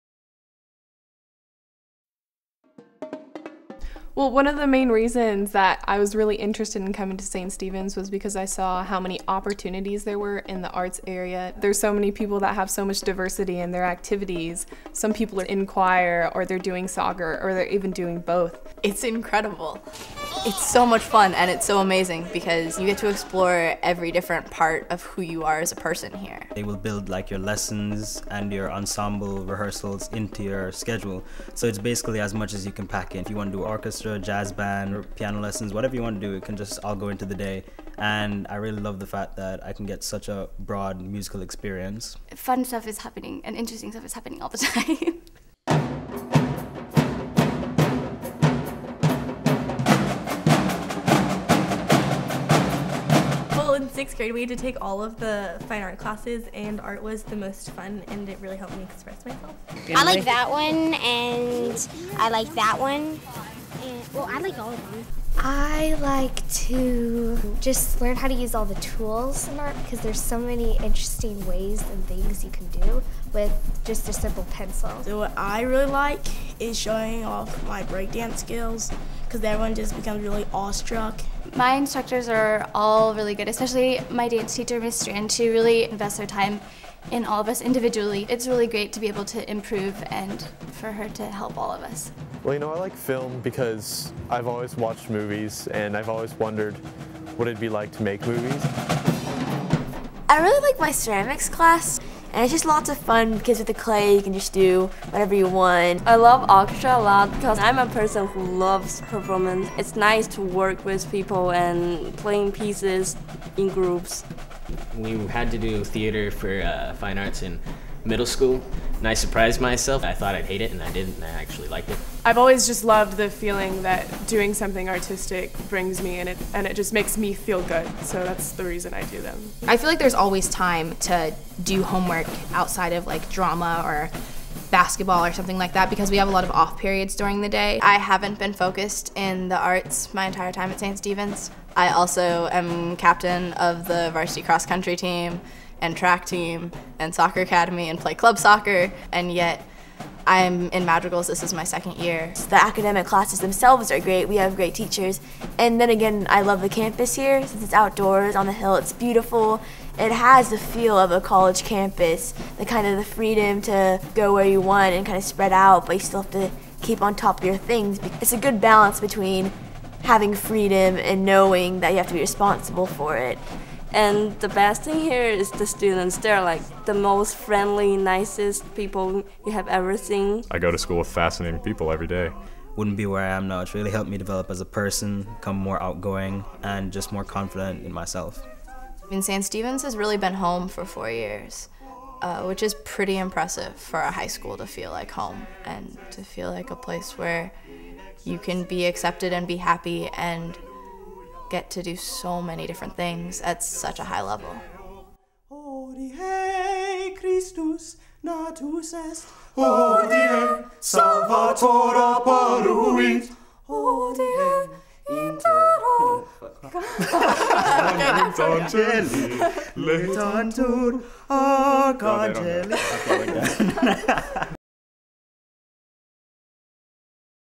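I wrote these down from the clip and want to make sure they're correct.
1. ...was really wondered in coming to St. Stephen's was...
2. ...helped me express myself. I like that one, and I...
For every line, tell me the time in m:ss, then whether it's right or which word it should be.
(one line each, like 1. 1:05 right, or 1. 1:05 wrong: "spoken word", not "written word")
1. 0:05 wrong: "interested", not "wondered"
2. 0:58 right.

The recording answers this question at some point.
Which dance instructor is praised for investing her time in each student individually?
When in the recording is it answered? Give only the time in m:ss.
1:24.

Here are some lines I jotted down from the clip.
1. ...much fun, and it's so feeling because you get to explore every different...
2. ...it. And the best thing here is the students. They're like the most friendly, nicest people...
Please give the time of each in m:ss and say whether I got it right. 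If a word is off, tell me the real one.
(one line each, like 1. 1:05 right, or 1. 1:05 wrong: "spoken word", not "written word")
1. 0:20 wrong: "amazing", not "feeling"
2. 2:53 right.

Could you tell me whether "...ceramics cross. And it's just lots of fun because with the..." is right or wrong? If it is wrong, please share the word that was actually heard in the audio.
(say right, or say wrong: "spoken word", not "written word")
wrong: "class", not "cross".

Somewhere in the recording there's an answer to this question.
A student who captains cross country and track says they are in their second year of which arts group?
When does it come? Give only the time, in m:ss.
2:30.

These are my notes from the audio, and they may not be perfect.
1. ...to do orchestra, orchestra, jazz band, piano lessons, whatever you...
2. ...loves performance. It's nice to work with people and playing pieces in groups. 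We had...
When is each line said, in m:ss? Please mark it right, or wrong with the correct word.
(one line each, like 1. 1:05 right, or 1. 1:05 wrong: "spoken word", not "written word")
1. 0:33 right
2. 1:48 right.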